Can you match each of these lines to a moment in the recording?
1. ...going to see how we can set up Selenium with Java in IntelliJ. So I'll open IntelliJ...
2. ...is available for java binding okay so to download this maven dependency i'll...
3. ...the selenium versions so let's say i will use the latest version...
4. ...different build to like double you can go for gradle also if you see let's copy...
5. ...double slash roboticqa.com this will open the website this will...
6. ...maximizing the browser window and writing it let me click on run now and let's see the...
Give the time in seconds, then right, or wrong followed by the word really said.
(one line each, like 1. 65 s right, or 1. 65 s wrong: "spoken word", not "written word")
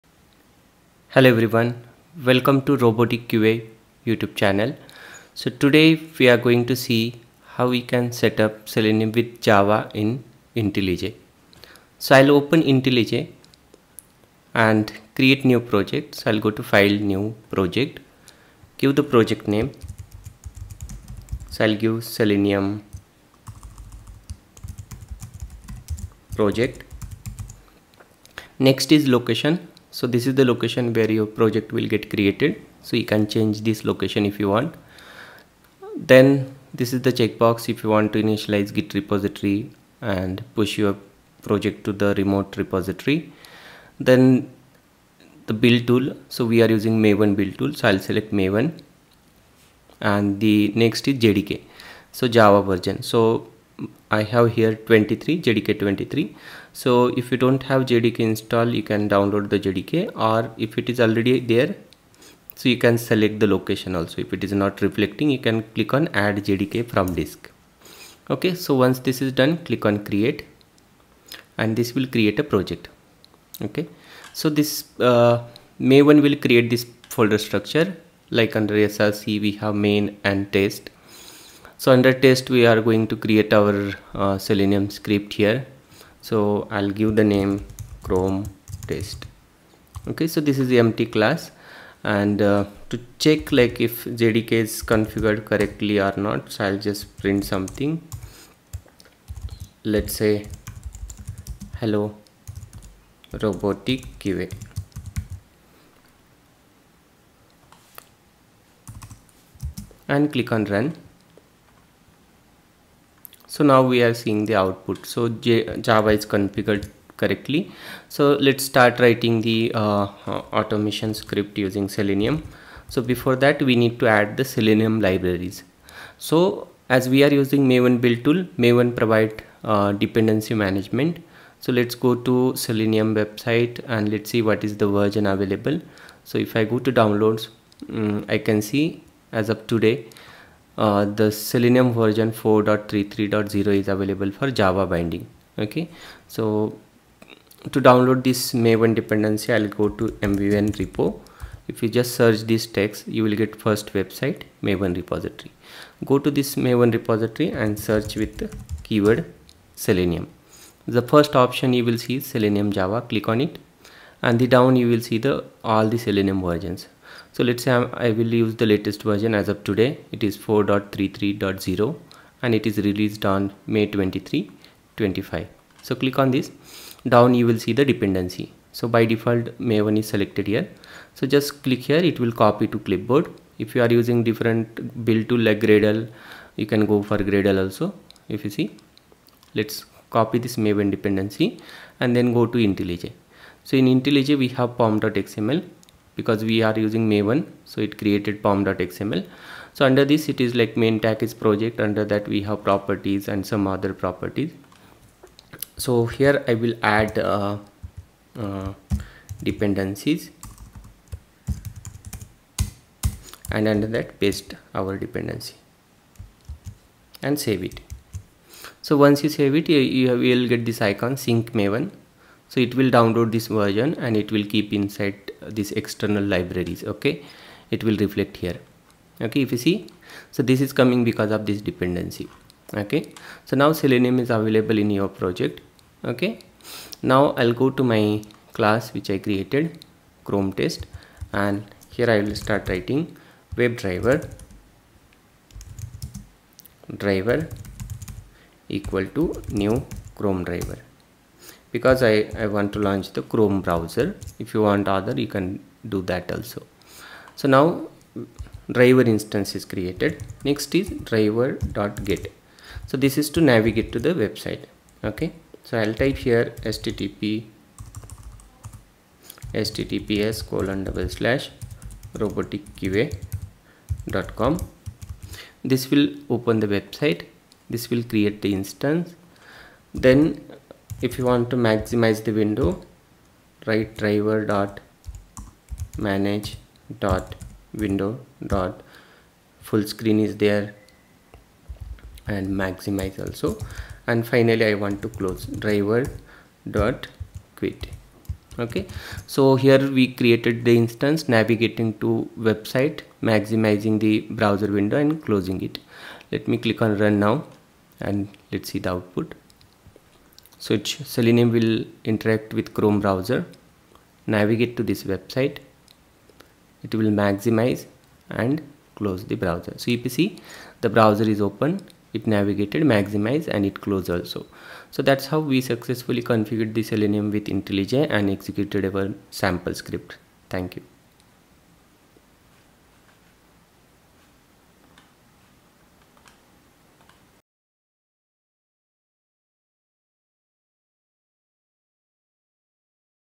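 1. 6 s right
2. 143 s right
3. 165 s right
4. 184 s wrong: "gradle", not "double"
5. 270 s right
6. 303 s wrong: "closing", not "writing".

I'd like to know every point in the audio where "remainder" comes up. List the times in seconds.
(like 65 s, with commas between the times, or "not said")
not said.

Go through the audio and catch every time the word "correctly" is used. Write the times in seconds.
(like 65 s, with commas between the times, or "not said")
95 s, 117 s.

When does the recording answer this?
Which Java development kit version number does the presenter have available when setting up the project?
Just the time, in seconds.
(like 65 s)
55 s.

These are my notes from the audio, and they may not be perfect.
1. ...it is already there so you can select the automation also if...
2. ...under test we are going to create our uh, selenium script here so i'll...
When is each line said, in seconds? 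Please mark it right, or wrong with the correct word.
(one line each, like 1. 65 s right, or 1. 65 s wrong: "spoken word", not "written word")
1. 60 s wrong: "location", not "automation"
2. 81 s right.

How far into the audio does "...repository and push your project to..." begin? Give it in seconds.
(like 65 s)
38 s.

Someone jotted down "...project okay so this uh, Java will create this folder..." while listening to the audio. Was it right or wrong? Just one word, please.
wrong.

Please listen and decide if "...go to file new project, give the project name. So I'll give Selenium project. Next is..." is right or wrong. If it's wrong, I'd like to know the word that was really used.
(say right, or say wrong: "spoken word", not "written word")
right.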